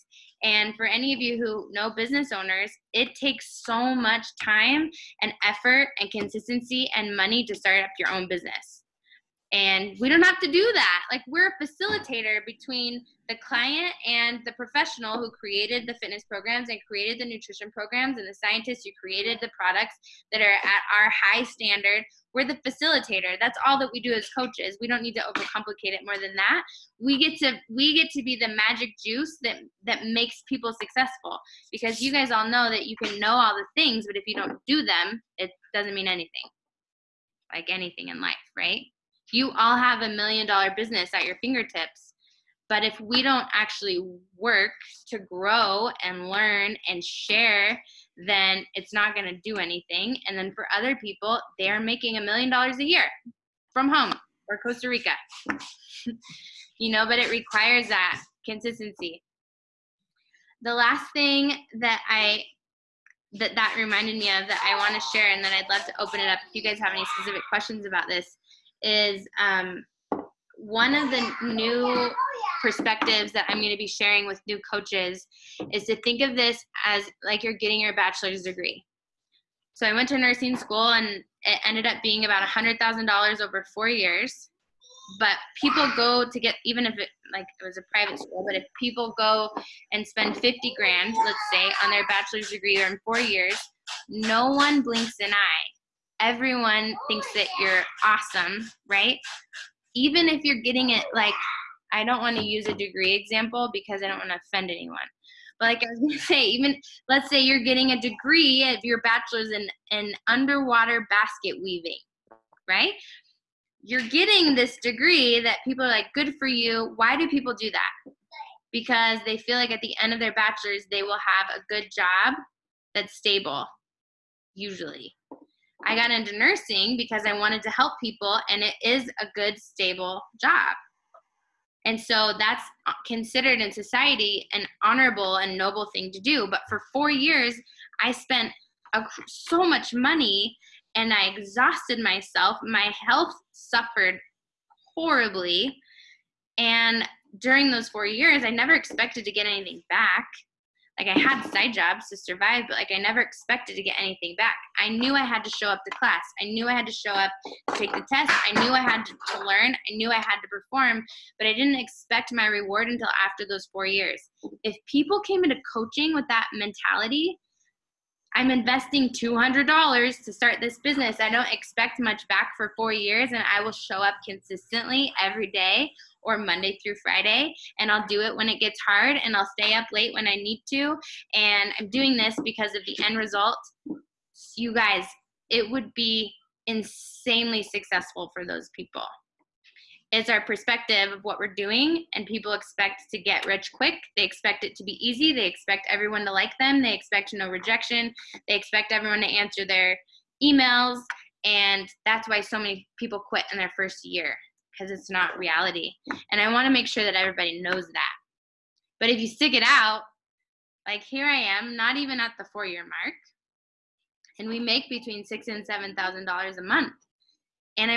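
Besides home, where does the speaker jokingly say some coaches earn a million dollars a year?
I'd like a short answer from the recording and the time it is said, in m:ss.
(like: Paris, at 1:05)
Costa Rica, at 0:54.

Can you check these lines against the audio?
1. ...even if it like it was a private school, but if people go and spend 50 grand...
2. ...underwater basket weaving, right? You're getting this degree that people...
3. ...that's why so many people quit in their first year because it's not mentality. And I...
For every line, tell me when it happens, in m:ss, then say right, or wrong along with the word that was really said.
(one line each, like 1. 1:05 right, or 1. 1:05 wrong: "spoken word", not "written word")
1. 1:26 right
2. 1:50 right
3. 3:22 wrong: "reality", not "mentality".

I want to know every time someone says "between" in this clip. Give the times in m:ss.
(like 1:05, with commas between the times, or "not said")
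0:12, 3:34.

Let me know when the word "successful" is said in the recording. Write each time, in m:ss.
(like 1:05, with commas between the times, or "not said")
0:30, 3:07.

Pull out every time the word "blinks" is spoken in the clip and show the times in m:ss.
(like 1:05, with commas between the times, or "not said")
1:34.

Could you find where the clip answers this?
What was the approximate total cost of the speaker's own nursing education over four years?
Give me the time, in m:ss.
1:22.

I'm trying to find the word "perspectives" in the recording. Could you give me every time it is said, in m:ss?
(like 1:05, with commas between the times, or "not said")
1:12, 3:10.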